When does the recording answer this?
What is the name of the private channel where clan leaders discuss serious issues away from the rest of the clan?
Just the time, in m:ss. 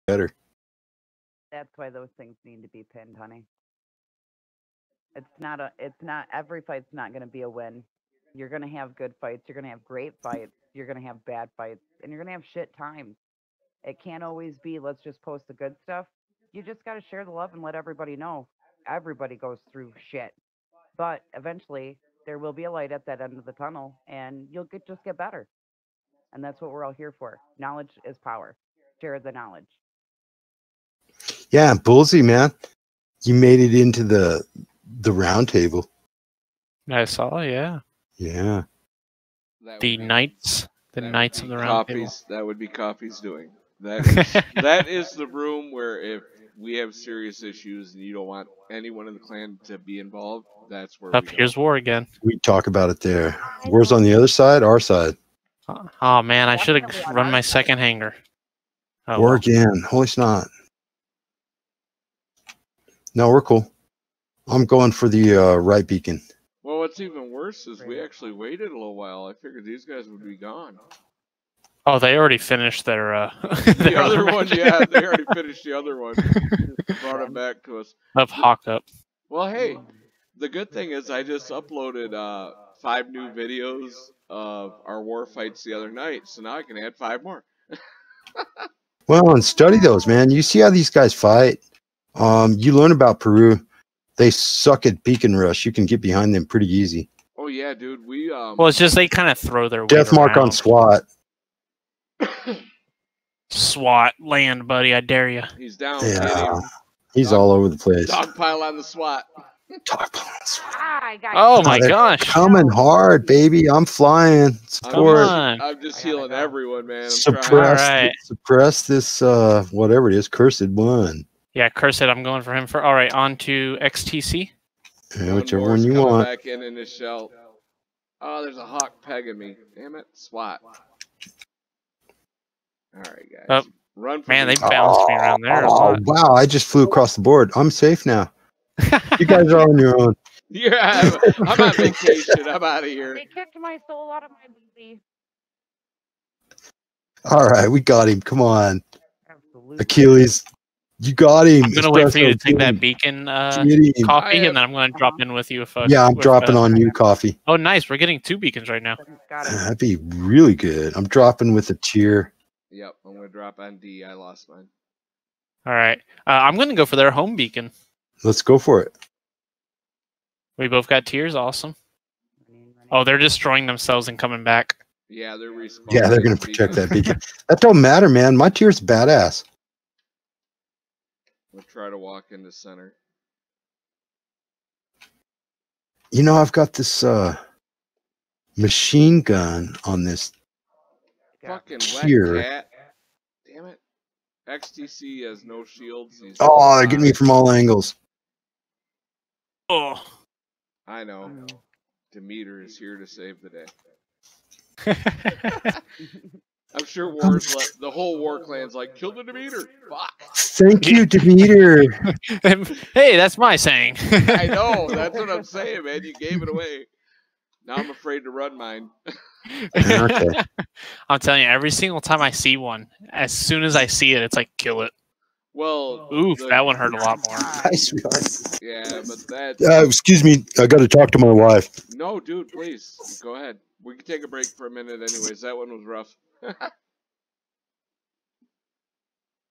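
0:35.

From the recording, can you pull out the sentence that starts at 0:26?
And that's what we're all here for.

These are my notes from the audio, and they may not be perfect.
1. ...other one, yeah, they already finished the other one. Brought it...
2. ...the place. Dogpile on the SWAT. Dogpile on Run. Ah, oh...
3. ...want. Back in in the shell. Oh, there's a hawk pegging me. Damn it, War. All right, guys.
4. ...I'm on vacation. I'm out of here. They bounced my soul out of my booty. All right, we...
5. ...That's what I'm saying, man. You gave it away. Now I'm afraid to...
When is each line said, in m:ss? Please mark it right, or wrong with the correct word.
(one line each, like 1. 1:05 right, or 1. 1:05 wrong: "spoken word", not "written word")
1. 1:13 right
2. 1:47 wrong: "SWAT", not "Run"
3. 2:06 wrong: "SWAT", not "War"
4. 2:21 wrong: "kicked", not "bounced"
5. 3:34 right.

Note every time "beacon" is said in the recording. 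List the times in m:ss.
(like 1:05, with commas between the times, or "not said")
1:05, 1:35, 2:32, 2:38, 2:47, 2:56.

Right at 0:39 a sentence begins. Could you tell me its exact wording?
The knights the knights of the round copies, table.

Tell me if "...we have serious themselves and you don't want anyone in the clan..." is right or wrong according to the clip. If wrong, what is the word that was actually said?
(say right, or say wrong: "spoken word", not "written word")
wrong: "issues", not "themselves".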